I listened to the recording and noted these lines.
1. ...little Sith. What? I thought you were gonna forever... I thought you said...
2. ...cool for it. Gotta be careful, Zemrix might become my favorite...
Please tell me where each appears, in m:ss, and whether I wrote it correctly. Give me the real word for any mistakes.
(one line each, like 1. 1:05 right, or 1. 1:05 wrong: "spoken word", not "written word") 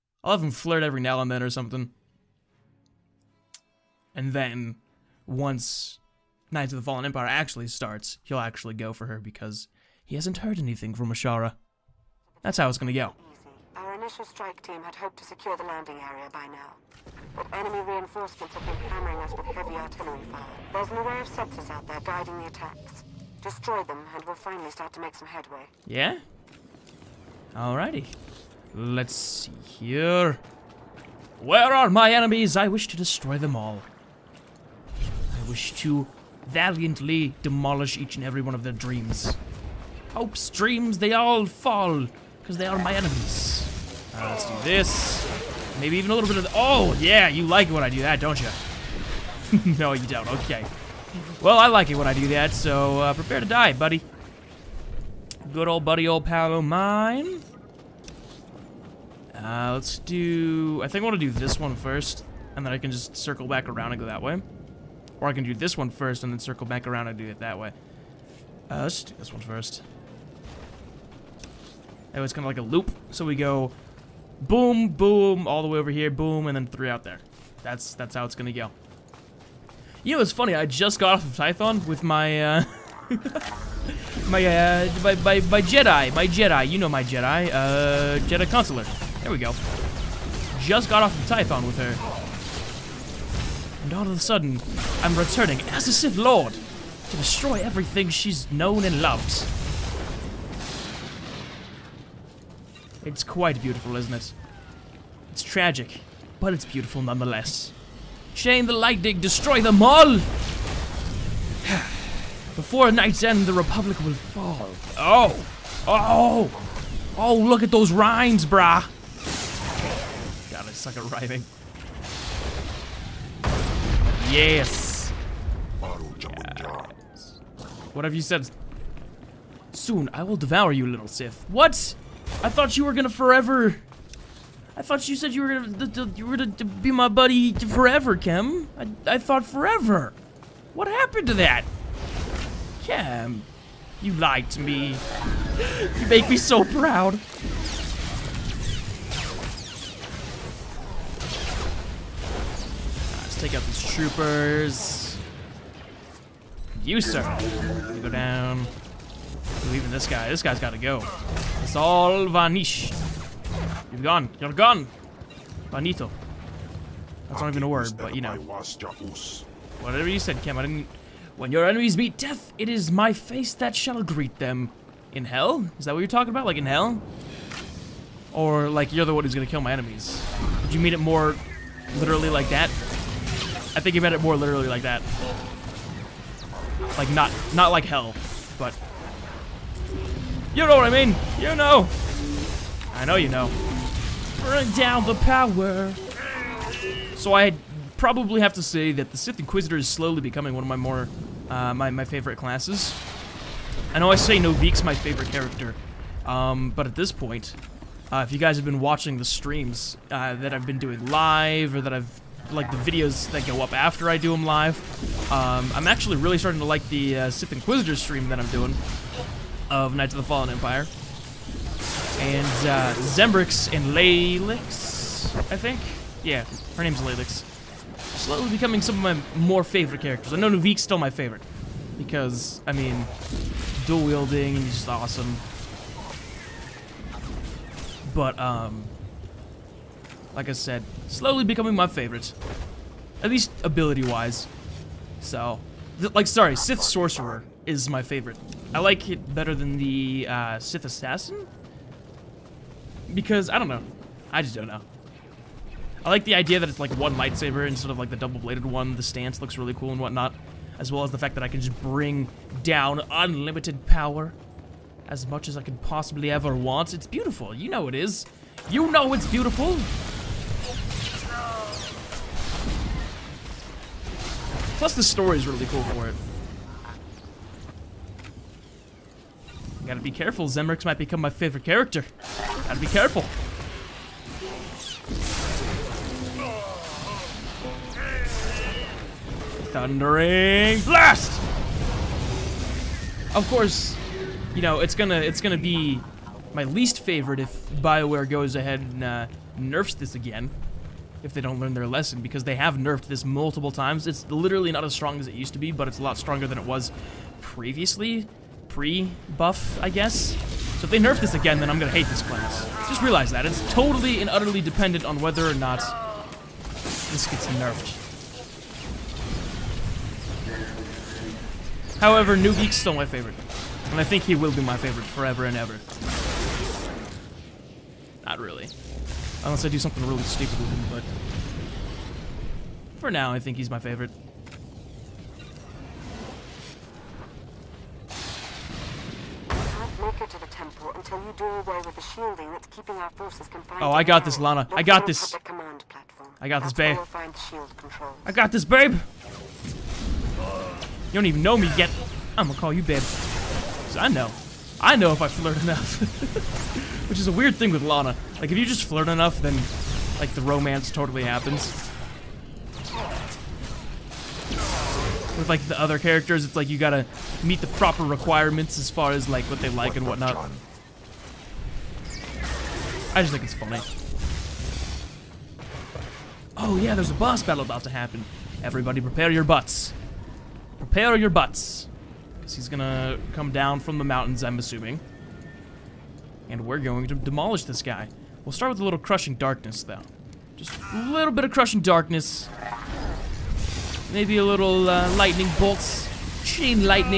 1. 2:10 right
2. 4:35 right.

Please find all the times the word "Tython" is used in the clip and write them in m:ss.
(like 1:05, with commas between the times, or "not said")
1:21, 1:31.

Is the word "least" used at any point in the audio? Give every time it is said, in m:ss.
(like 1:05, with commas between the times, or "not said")
4:03, 4:56.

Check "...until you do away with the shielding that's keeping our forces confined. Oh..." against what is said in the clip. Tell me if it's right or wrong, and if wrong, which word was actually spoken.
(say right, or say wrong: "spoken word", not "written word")
right.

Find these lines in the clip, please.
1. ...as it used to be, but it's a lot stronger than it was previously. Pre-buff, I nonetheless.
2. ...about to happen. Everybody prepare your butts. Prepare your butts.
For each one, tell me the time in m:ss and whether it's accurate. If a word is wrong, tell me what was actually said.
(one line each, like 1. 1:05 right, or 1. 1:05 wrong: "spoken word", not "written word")
1. 5:05 wrong: "guess", not "nonetheless"
2. 6:17 right.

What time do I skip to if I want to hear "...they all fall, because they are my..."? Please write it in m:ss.
0:40.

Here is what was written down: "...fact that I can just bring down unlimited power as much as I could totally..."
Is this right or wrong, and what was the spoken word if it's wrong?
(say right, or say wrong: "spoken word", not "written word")
wrong: "possibly", not "totally".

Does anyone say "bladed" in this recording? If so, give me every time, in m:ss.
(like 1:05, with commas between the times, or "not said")
4:18.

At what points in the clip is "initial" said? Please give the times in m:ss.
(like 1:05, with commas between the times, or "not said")
0:13.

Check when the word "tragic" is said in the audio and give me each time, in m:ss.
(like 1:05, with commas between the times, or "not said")
1:45.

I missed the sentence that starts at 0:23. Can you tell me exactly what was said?
Destroy them, and we'll finally start to make some headway.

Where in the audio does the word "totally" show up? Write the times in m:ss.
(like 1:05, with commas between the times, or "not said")
5:13, 6:00.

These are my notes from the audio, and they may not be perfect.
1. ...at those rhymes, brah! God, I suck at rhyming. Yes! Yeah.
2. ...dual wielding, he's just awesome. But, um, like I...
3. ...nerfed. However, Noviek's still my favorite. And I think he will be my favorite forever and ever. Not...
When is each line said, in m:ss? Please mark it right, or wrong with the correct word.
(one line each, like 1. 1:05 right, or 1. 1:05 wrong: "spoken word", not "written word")
1. 1:57 right
2. 3:53 right
3. 5:17 right.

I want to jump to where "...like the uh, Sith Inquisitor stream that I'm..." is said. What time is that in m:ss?
3:36.